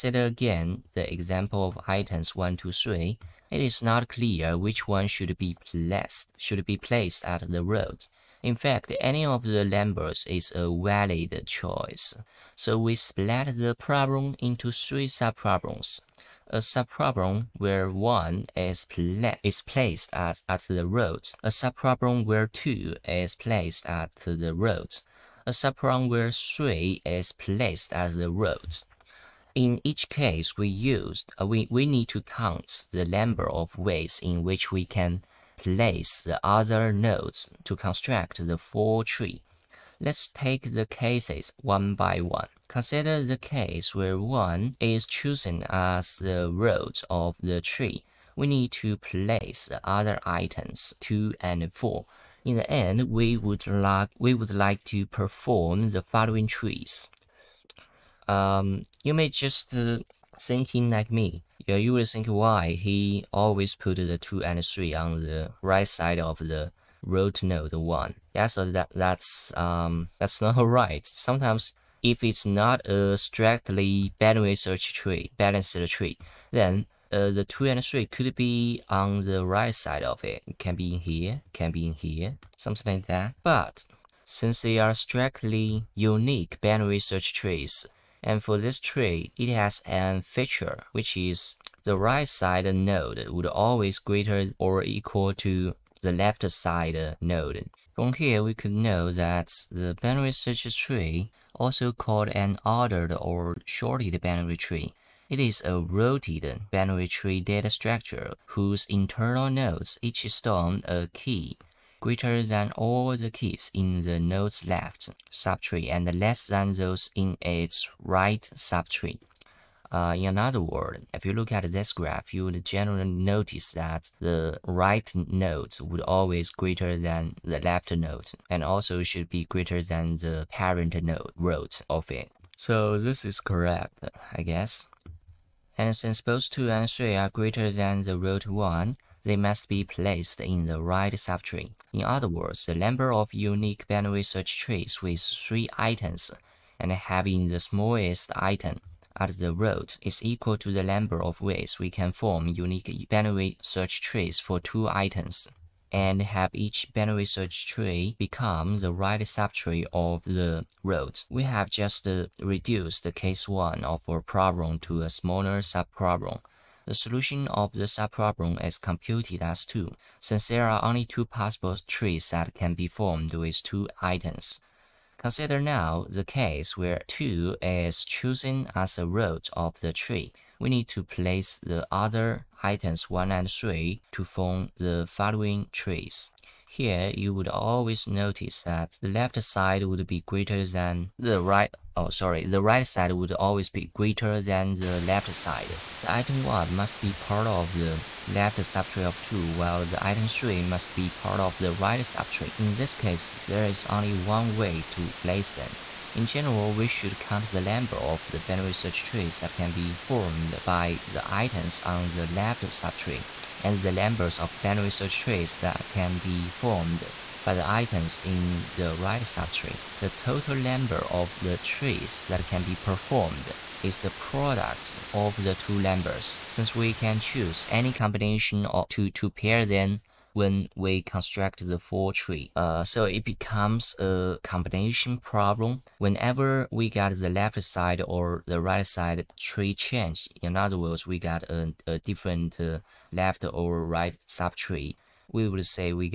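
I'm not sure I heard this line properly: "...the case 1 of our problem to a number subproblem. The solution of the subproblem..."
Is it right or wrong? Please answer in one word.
wrong.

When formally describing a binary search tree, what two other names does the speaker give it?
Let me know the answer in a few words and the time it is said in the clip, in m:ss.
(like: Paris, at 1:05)
Ordered or sorted binary tree, at 1:42.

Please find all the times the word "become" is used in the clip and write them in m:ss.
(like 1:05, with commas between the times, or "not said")
2:38, 3:53.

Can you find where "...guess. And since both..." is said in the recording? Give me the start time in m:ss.
2:14.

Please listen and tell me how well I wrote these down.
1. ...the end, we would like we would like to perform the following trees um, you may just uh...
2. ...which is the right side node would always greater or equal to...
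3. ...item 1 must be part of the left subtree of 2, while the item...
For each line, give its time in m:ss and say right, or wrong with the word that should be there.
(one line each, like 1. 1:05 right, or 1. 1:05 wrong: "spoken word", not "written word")
1. 0:52 right
2. 1:30 right
3. 3:16 right.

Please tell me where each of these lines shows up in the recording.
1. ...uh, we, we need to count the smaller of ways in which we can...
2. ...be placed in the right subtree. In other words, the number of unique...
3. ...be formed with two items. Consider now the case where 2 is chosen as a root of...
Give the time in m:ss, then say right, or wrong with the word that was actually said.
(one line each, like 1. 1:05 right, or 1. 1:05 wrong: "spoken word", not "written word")
1. 0:31 wrong: "number", not "smaller"
2. 2:19 right
3. 2:52 right.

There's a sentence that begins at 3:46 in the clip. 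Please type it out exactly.
Since we can choose any combination of two to pair them when we construct the full tree.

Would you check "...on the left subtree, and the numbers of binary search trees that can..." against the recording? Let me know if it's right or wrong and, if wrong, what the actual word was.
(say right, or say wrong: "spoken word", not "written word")
right.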